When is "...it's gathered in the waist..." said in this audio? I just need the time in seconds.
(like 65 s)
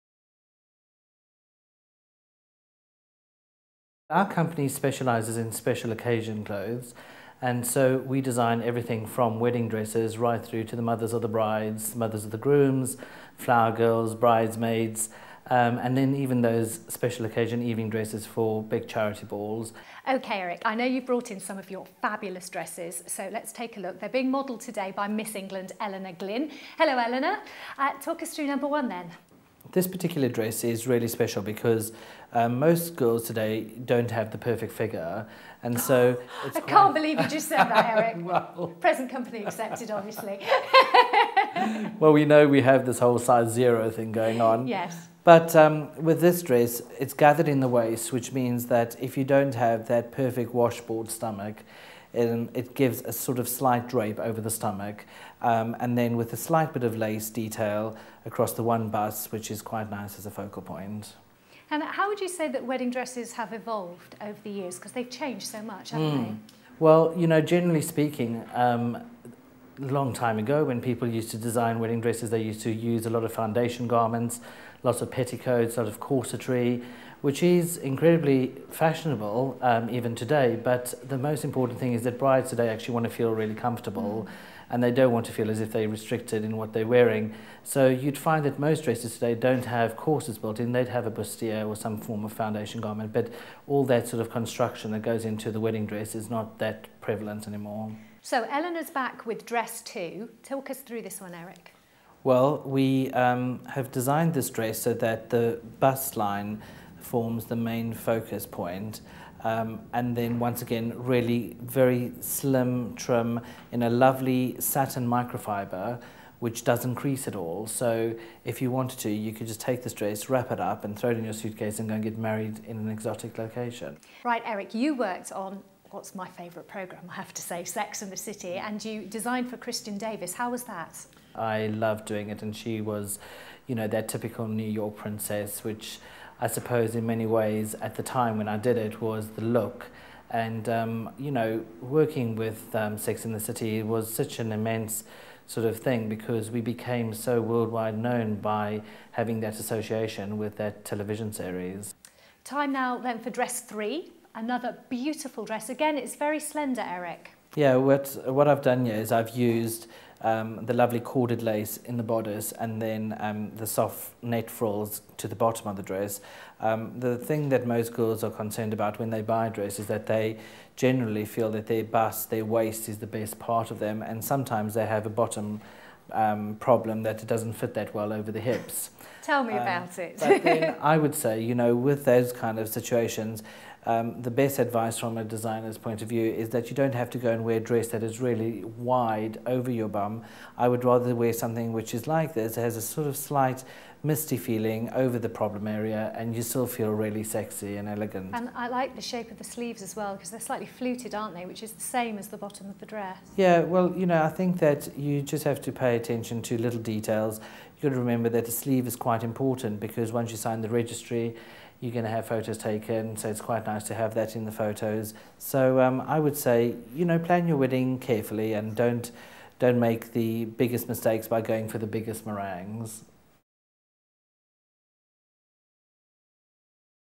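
46 s.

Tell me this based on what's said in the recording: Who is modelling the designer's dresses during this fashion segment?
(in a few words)
Eleanor Glynn.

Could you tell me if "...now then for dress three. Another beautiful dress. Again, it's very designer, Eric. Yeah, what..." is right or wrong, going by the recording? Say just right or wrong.
wrong.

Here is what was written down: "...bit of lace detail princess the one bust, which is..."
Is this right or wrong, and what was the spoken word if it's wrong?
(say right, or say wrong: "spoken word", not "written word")
wrong: "across", not "princess".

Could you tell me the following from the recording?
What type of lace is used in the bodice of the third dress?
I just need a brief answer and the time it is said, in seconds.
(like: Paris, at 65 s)
corded lace, at 161 s.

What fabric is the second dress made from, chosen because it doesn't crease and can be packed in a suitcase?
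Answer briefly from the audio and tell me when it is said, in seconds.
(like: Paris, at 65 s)
satin microfiber, at 114 s.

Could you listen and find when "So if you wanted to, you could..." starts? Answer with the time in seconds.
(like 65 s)
117 s.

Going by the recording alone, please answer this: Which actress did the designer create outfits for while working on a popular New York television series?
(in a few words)
Kristin Davis.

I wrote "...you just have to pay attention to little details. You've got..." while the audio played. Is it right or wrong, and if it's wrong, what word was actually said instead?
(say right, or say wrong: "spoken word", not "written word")
right.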